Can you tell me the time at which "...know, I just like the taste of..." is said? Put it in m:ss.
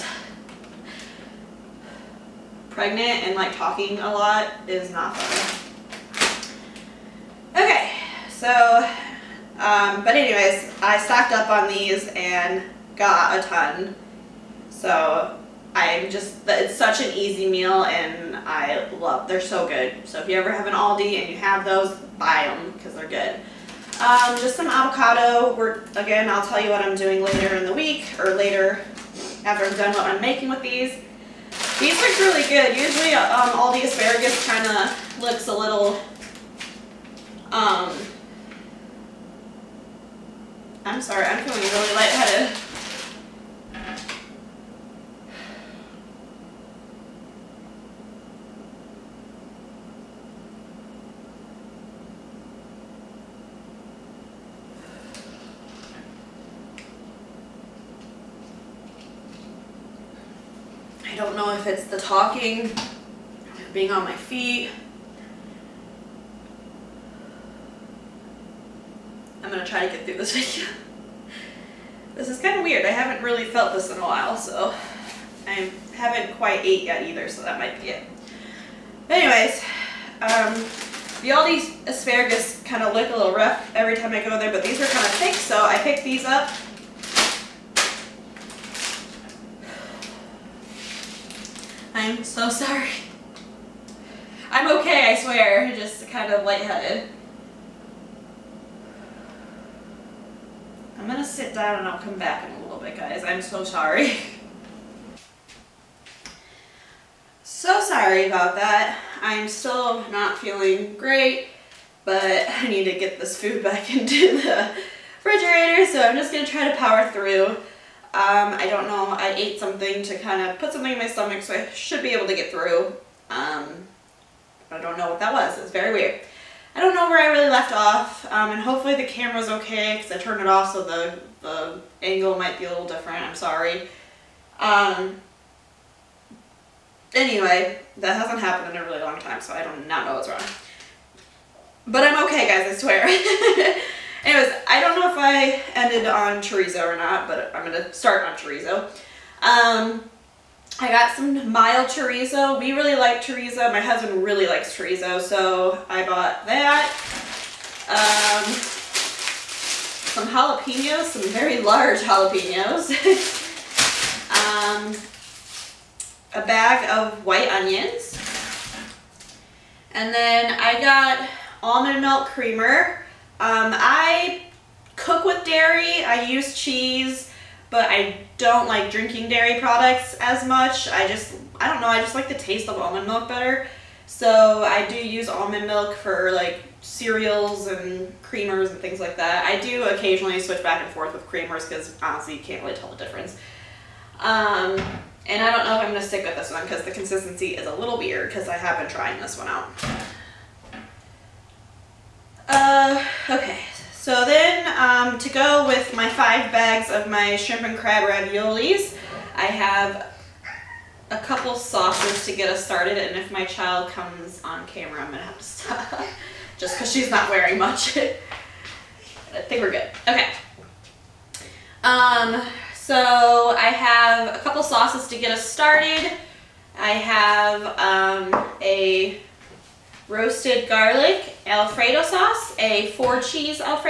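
3:01.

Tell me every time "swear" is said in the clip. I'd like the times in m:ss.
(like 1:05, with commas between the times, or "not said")
1:35, 2:22.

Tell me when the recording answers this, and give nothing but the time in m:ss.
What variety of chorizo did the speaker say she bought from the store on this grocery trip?
2:31.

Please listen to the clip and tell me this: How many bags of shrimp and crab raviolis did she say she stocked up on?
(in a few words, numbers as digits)
5.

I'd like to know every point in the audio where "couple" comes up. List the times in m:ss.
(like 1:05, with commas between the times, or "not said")
3:31, 3:44.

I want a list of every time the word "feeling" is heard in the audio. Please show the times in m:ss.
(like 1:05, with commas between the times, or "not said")
0:41, 1:50.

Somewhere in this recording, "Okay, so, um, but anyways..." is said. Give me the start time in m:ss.
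0:07.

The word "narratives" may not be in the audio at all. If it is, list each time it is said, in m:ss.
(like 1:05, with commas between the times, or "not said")
not said.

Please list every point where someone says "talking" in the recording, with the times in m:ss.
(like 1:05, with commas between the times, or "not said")
0:03, 1:01.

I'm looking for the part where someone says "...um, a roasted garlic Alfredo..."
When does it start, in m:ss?
3:47.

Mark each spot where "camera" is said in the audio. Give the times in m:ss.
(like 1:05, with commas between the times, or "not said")
2:09, 3:34.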